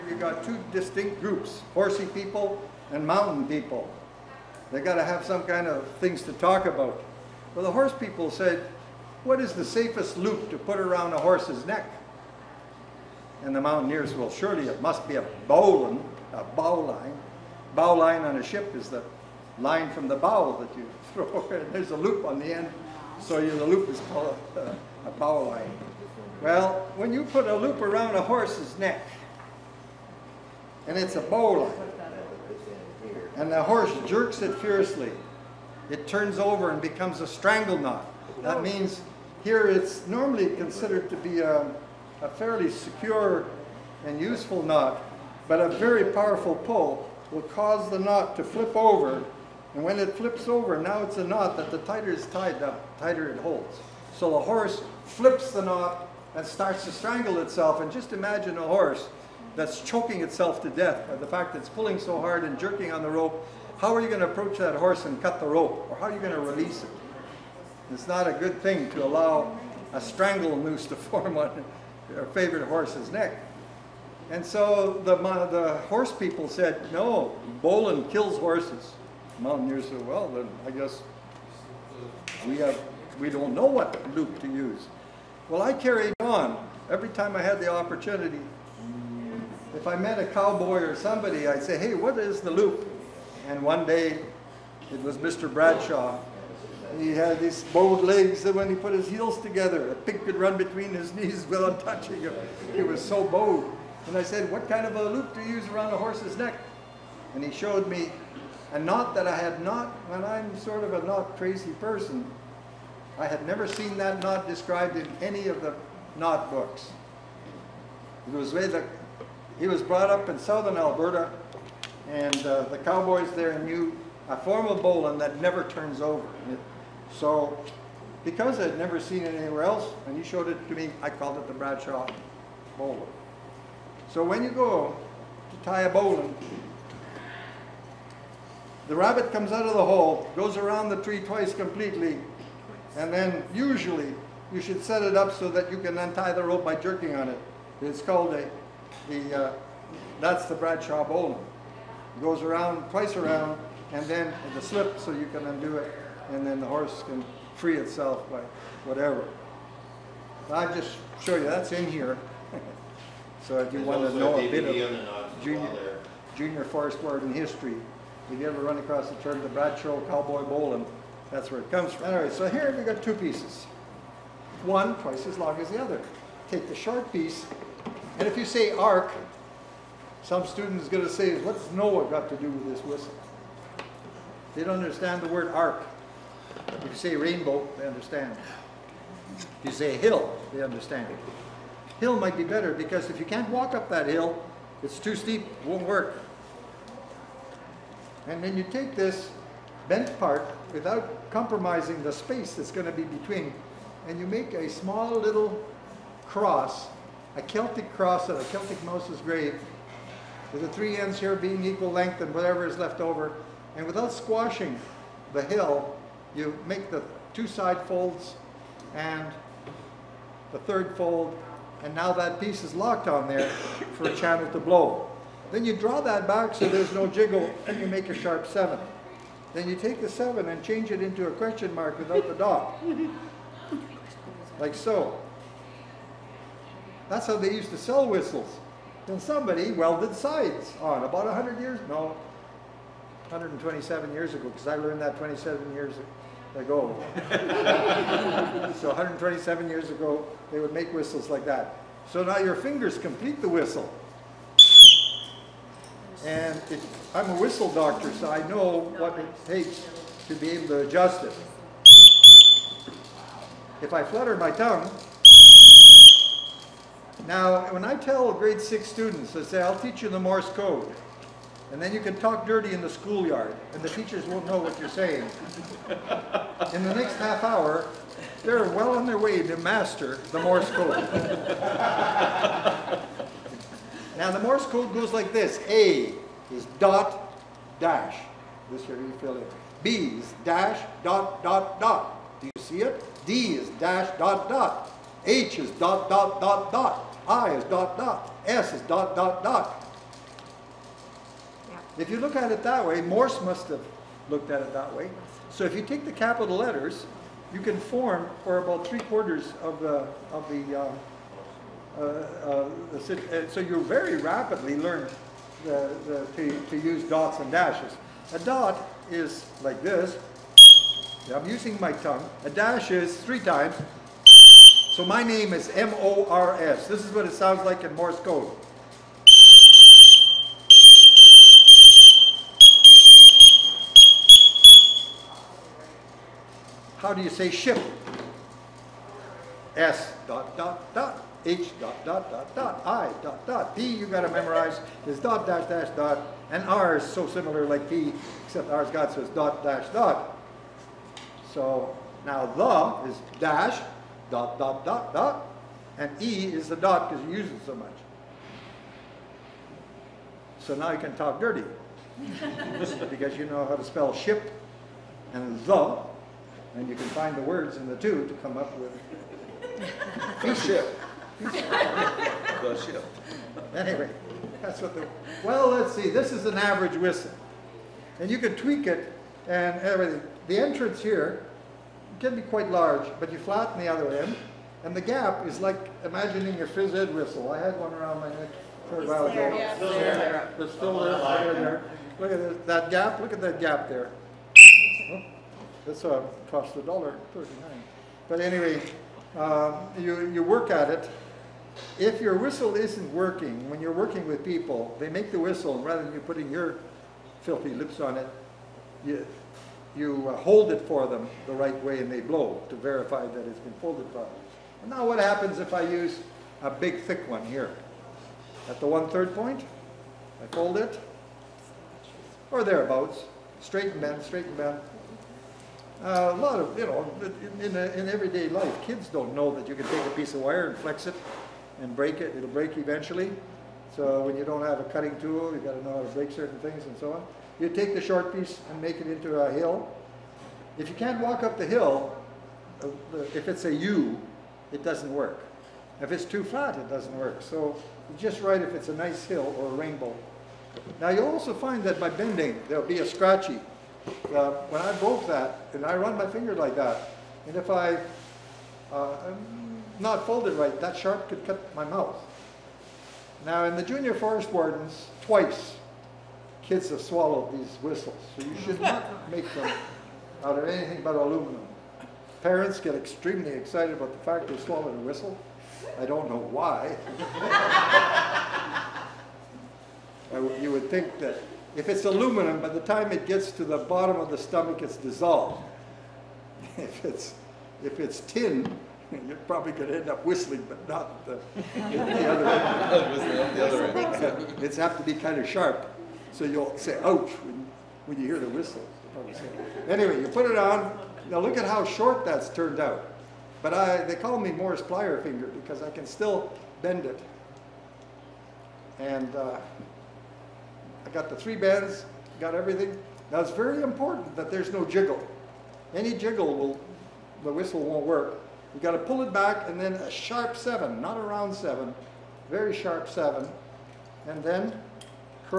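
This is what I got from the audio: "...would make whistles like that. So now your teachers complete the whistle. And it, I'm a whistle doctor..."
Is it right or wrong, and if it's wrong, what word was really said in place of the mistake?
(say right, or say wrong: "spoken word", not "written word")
wrong: "fingers", not "teachers".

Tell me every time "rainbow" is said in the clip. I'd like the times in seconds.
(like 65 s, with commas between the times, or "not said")
187 s, 449 s.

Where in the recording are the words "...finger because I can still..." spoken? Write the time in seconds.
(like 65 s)
505 s.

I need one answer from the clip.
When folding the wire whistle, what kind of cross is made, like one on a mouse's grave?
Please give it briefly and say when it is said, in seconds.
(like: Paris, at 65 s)
Celtic cross, at 207 s.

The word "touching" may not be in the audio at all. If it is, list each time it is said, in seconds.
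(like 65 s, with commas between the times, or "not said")
101 s.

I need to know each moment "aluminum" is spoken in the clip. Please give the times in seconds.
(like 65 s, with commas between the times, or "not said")
471 s, 482 s.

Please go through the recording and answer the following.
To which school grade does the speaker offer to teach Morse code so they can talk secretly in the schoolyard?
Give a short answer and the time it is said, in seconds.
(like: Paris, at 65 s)
Grade 6, at 268 s.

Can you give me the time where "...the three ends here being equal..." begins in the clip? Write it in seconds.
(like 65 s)
210 s.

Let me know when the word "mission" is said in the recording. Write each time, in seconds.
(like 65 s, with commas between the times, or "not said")
not said.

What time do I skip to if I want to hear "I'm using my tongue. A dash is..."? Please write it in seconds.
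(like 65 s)
321 s.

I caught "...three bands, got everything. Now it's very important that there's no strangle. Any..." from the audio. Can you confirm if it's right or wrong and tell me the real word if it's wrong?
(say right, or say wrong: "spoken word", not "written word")
wrong: "jiggle", not "strangle".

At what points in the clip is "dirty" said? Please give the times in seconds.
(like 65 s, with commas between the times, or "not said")
272 s, 361 s.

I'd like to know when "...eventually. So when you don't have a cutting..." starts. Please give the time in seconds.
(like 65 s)
432 s.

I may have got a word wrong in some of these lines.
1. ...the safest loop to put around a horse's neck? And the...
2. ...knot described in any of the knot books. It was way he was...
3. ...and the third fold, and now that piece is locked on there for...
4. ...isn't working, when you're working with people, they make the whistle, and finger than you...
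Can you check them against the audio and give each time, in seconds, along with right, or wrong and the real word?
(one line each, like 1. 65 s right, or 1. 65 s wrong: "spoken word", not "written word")
1. 9 s right
2. 114 s right
3. 218 s right
4. 402 s wrong: "rather", not "finger".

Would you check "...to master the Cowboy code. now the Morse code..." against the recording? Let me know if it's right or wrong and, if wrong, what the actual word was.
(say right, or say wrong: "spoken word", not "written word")
wrong: "Morse", not "Cowboy".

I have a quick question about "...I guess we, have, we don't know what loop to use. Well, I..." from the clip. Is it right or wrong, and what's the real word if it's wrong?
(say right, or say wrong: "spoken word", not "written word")
right.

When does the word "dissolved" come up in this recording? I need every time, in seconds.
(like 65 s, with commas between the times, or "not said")
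484 s.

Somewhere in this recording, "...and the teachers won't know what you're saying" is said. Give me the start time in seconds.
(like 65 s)
273 s.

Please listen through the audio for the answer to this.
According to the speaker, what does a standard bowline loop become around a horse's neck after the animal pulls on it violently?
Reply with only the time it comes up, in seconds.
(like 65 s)
37 s.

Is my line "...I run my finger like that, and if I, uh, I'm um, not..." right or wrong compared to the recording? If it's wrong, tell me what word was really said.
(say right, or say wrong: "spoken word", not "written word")
right.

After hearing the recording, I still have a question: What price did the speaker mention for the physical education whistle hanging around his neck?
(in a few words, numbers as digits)
$1.39.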